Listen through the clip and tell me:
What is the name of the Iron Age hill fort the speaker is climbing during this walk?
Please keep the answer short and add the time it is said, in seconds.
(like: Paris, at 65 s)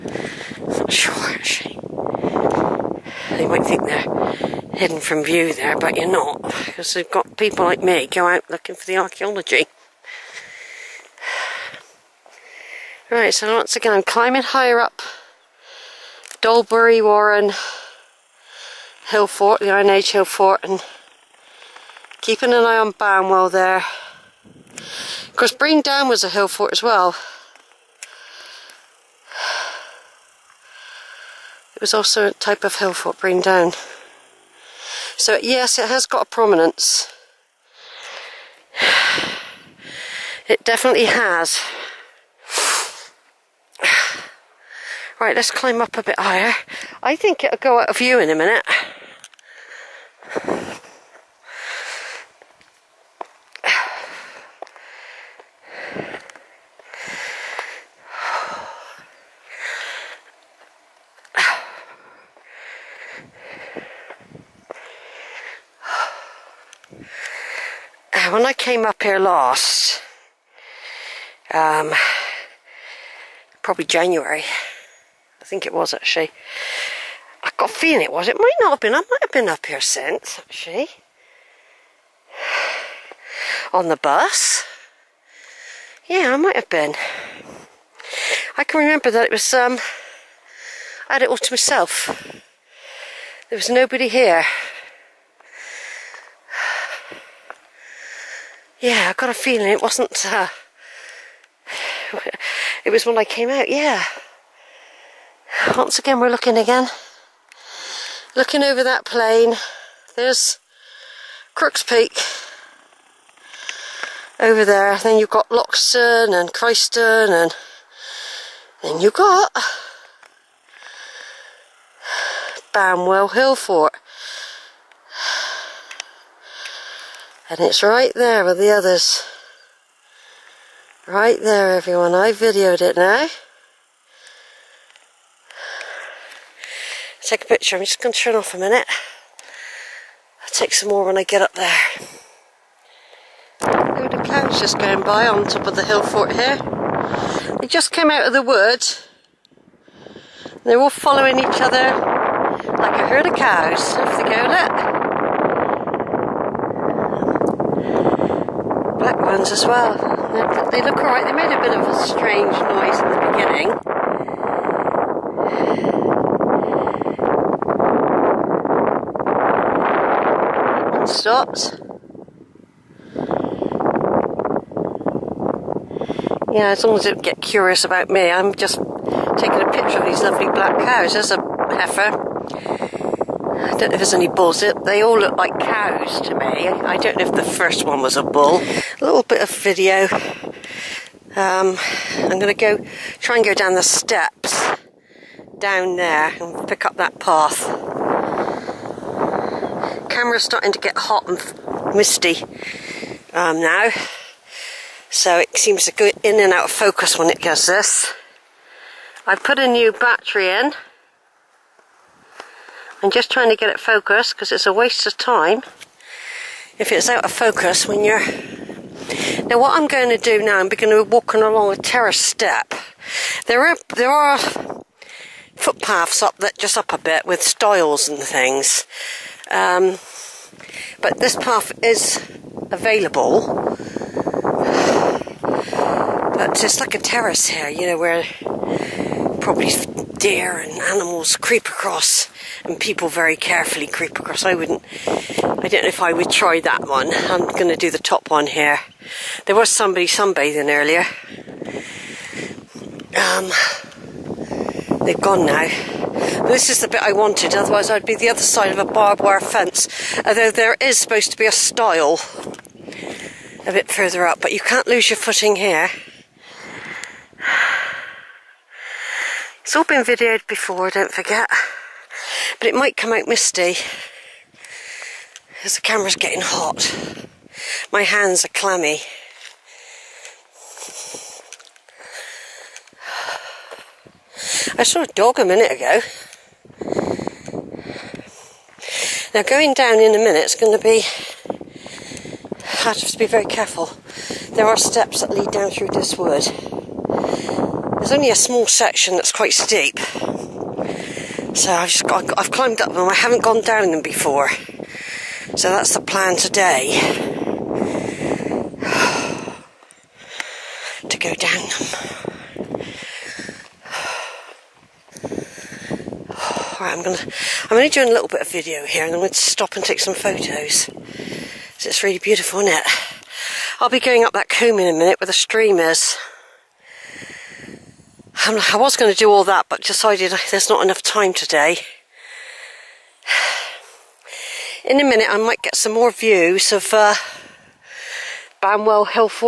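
Dolebury Warren, at 16 s.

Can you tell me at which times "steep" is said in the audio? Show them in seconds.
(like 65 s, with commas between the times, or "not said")
299 s.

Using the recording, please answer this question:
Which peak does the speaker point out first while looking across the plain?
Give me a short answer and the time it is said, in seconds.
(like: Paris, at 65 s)
Crooks Peak, at 111 s.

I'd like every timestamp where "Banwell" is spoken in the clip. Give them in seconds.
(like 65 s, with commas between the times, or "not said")
22 s, 122 s.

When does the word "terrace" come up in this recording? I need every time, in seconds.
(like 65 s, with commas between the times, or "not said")
221 s, 236 s.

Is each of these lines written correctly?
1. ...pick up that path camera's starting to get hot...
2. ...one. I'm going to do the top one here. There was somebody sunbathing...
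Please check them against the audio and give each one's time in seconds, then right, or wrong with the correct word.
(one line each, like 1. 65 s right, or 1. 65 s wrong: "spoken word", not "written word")
1. 196 s right
2. 246 s right.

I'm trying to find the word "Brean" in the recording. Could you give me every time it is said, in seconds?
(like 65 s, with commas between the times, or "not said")
25 s, 33 s.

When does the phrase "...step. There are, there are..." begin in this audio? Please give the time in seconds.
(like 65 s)
222 s.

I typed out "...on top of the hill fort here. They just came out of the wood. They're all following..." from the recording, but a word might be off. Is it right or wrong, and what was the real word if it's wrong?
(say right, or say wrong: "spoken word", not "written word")
right.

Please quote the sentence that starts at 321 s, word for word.
So it's really beautiful, isn't it?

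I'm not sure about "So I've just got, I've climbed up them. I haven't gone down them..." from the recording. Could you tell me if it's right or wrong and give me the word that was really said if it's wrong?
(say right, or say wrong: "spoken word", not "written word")
right.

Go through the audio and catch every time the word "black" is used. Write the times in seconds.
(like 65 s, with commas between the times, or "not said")
158 s, 180 s.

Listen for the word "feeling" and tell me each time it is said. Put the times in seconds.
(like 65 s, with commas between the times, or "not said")
77 s, 99 s.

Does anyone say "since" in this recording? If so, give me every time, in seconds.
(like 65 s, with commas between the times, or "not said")
79 s.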